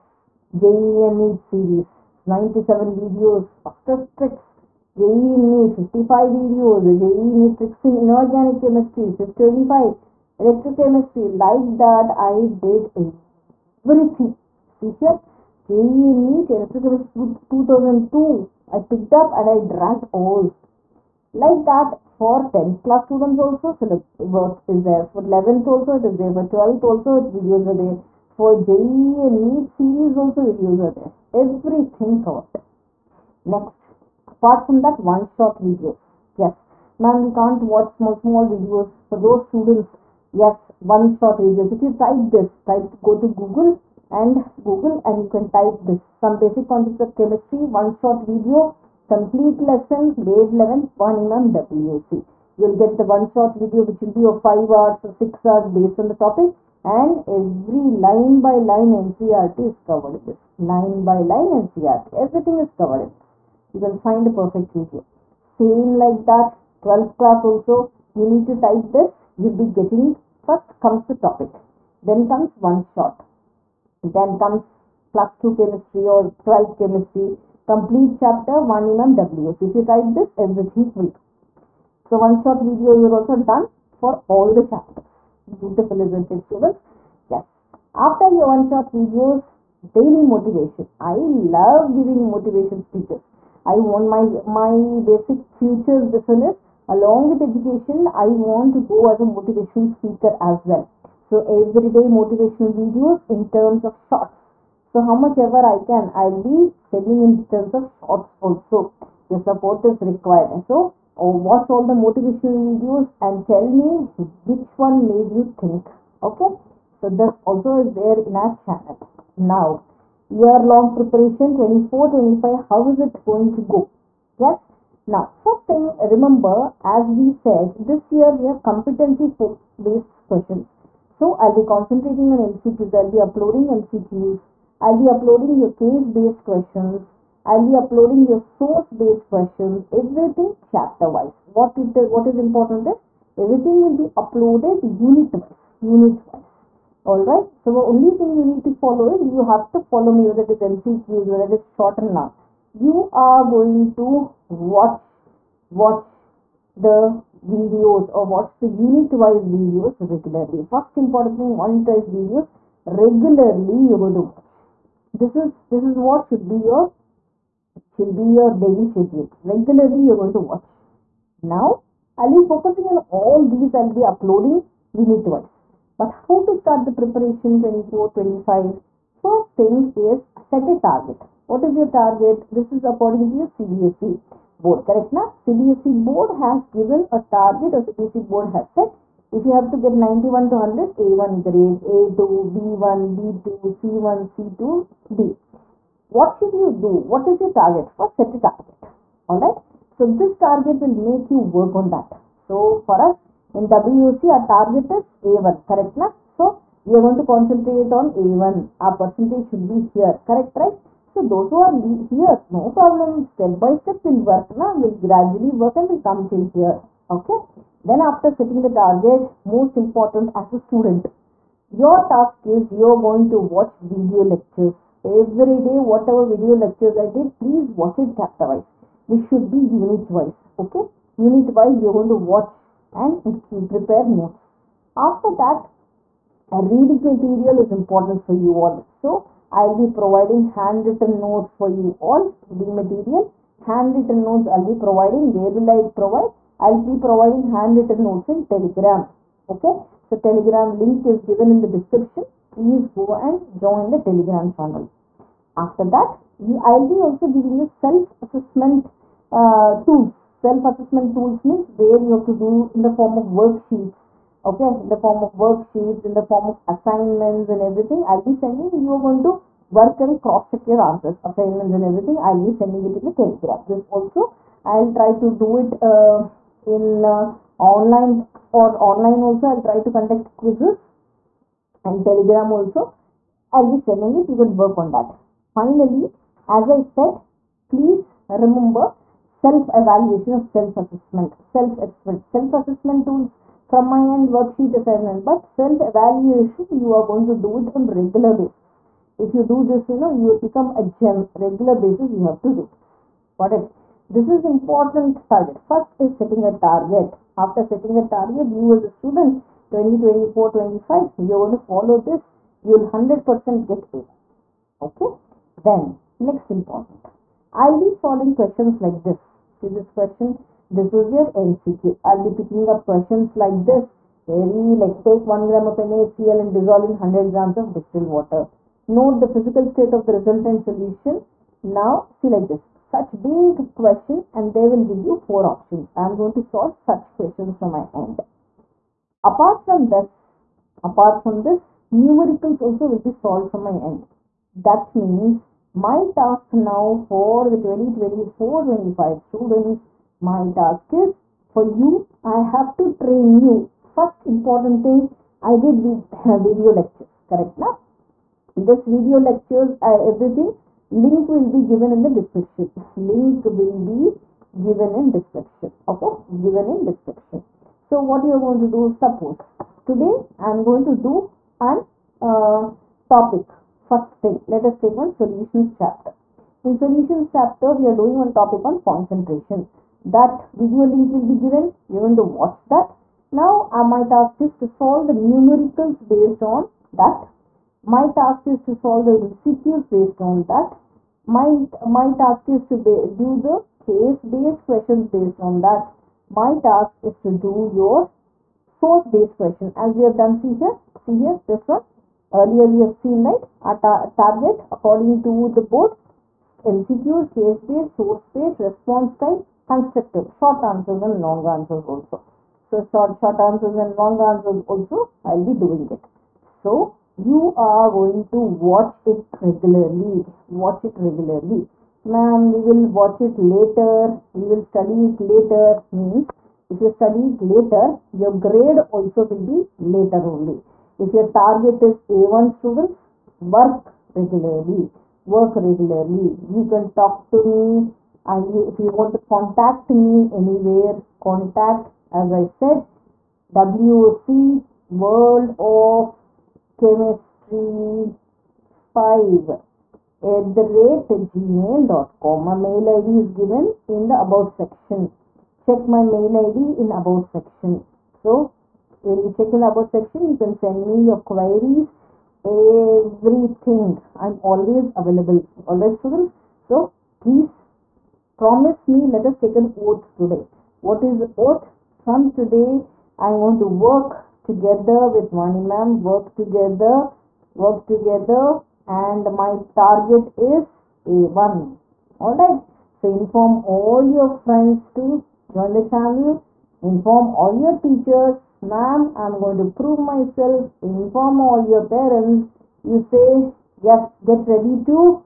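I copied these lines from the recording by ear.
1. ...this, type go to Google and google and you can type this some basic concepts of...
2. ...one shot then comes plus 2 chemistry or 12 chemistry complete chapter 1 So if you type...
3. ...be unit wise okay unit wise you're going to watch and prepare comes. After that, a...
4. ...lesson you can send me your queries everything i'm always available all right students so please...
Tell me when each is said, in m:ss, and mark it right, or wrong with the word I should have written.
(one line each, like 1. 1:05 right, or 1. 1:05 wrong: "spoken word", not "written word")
1. 0:42 right
2. 1:12 right
3. 3:49 wrong: "notes", not "comes"
4. 7:39 wrong: "section", not "lesson".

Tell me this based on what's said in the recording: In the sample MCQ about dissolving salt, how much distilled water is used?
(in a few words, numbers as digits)
100 grams.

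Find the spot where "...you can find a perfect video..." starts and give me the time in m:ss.
1:03.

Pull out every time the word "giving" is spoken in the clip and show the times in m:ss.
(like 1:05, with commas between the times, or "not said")
1:31, 4:17.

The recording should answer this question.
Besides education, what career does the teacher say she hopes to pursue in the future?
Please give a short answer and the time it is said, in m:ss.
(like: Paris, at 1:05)
motivational speaker, at 1:39.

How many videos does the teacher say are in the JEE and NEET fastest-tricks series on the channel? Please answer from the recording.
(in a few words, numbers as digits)
97.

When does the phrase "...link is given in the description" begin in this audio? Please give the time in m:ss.
4:10.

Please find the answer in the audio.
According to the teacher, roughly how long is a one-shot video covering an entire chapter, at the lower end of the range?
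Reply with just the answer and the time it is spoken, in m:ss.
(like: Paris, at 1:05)
5 hours, at 0:54.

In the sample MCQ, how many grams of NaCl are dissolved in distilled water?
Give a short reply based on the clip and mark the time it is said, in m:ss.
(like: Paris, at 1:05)
1 gram, at 5:25.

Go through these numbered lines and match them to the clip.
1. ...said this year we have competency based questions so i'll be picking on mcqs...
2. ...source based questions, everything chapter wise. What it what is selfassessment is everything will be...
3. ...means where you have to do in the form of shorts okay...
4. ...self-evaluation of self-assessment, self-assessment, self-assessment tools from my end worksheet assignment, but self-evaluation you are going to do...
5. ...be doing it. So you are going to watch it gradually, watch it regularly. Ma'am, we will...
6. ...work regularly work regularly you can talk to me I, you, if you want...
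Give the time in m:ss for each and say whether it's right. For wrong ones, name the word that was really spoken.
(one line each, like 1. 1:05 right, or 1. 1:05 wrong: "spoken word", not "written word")
1. 2:07 wrong: "concentrating", not "picking"
2. 2:18 wrong: "important", not "selfassessment"
3. 4:21 wrong: "worksheets", not "shorts"
4. 4:49 right
5. 6:55 wrong: "regularly", not "gradually"
6. 7:13 right.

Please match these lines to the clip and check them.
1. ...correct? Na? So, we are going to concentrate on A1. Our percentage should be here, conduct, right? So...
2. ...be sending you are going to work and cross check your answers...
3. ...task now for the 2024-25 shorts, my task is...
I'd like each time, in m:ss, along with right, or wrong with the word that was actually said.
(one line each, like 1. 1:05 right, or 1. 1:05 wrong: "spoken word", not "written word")
1. 3:25 wrong: "correct", not "conduct"
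2. 4:28 right
3. 5:46 wrong: "students", not "shorts".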